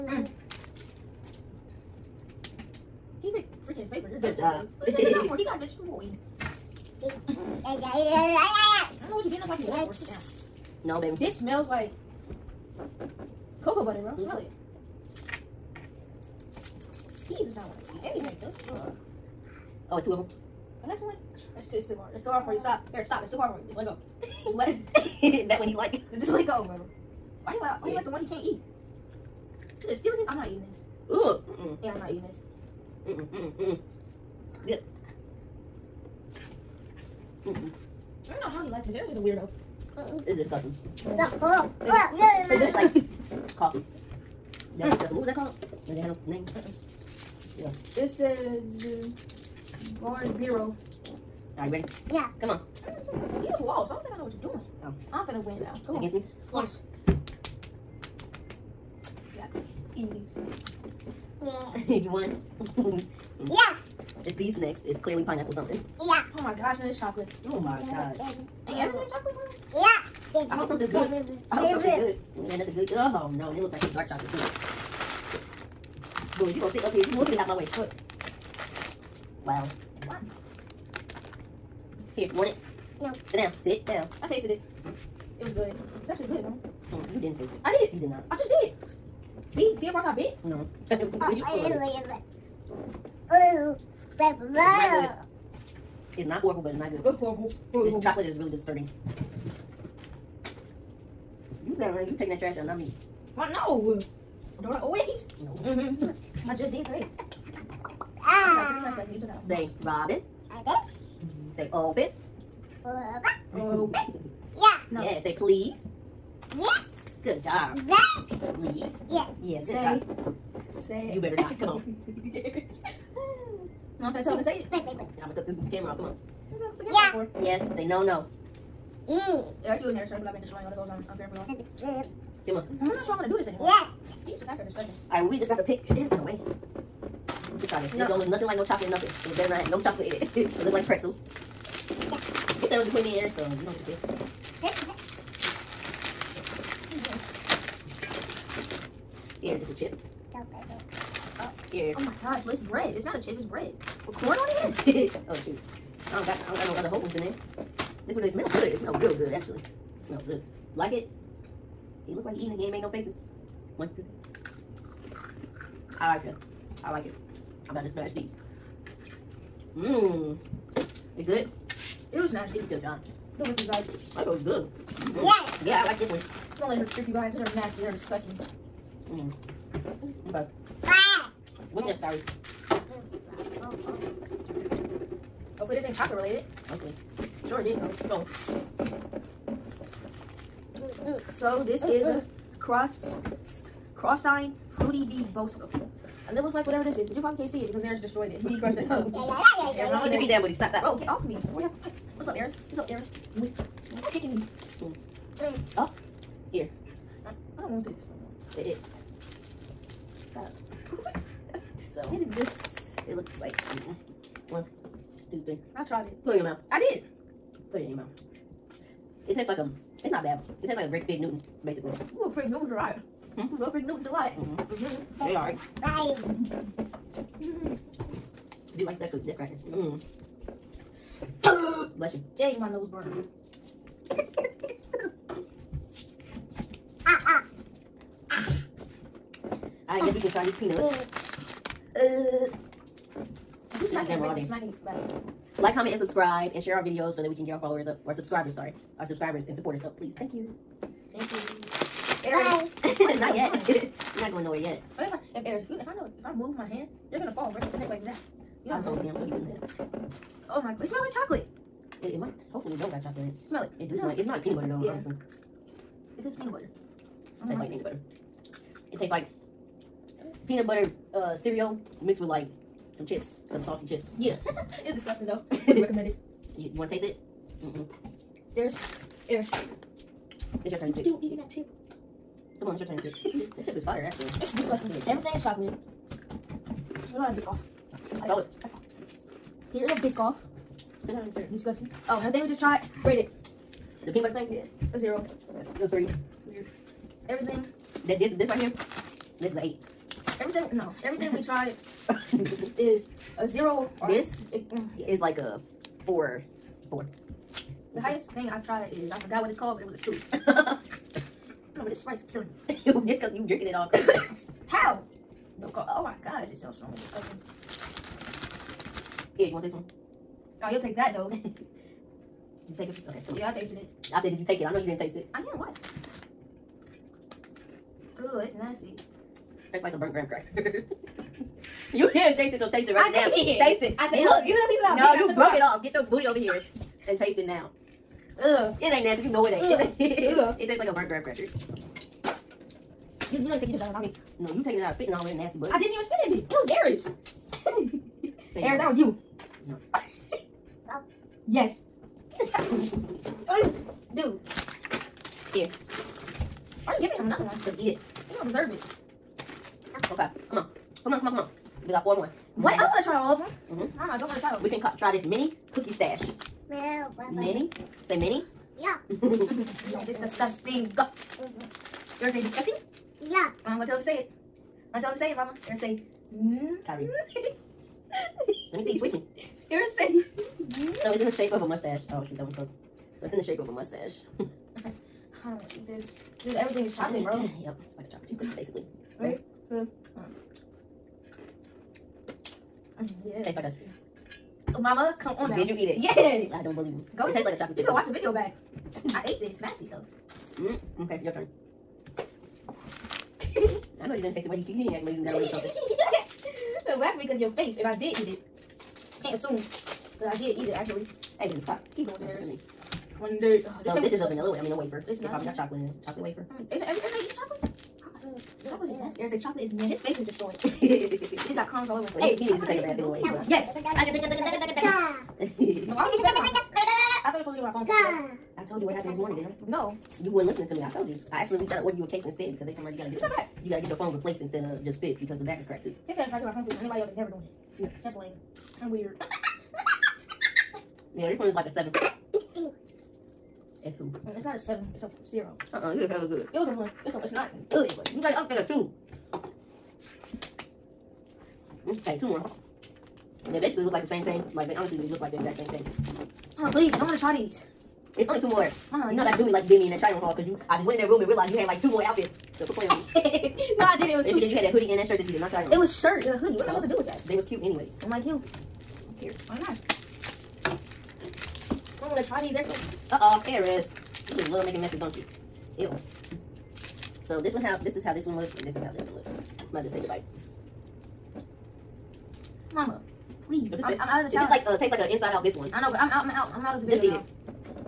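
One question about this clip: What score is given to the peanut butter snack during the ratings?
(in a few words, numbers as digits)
3.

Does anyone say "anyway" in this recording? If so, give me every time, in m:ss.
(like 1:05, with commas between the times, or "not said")
7:02, 7:47.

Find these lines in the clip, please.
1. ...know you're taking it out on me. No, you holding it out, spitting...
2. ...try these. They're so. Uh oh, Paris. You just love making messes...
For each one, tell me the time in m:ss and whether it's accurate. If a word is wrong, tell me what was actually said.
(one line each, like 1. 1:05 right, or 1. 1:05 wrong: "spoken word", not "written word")
1. 5:43 wrong: "taking", not "holding"
2. 7:52 right.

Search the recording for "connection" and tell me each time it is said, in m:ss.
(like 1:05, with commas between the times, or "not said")
not said.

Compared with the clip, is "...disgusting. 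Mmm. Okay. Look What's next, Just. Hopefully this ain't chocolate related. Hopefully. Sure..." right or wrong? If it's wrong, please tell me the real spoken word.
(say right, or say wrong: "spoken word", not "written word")
wrong: "Gary", not "Just".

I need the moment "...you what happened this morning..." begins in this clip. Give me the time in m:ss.
7:08.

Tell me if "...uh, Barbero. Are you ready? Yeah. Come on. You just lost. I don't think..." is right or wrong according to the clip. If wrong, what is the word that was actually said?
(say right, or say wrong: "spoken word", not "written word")
right.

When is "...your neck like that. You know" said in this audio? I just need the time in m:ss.
4:17.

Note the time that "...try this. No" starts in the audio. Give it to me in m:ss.
2:17.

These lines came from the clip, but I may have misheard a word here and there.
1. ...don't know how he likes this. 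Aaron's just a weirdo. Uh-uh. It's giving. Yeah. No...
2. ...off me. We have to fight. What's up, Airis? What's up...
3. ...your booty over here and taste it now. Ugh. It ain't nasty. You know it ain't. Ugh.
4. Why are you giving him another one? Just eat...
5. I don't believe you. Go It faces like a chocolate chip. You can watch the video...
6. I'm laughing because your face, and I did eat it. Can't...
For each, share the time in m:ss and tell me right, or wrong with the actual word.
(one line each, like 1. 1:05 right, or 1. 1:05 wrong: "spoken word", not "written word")
1. 0:38 wrong: "disgusting", not "giving"
2. 3:21 right
3. 5:35 right
4. 5:56 right
5. 6:36 wrong: "tastes", not "faces"
6. 6:46 right.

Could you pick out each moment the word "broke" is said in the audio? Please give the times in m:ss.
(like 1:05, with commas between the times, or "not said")
5:35, 6:22.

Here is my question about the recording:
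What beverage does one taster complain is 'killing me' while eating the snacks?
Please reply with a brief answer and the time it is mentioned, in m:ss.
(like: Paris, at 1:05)
Sprite, at 5:12.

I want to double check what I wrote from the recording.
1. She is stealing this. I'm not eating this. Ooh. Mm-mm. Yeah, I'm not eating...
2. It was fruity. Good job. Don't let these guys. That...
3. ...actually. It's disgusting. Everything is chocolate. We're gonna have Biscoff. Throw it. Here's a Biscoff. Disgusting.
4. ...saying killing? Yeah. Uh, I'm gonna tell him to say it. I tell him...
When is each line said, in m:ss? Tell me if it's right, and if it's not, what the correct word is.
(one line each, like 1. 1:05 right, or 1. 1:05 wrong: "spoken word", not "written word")
1. 0:29 right
2. 2:52 wrong: "nasty", not "fruity"
3. 4:44 right
4. 6:12 wrong: "disgusting", not "killing".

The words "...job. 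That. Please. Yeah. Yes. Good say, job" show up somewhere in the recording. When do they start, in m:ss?
1:57.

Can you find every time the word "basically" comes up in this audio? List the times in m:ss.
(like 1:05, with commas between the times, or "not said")
3:41, 6:28, 7:33.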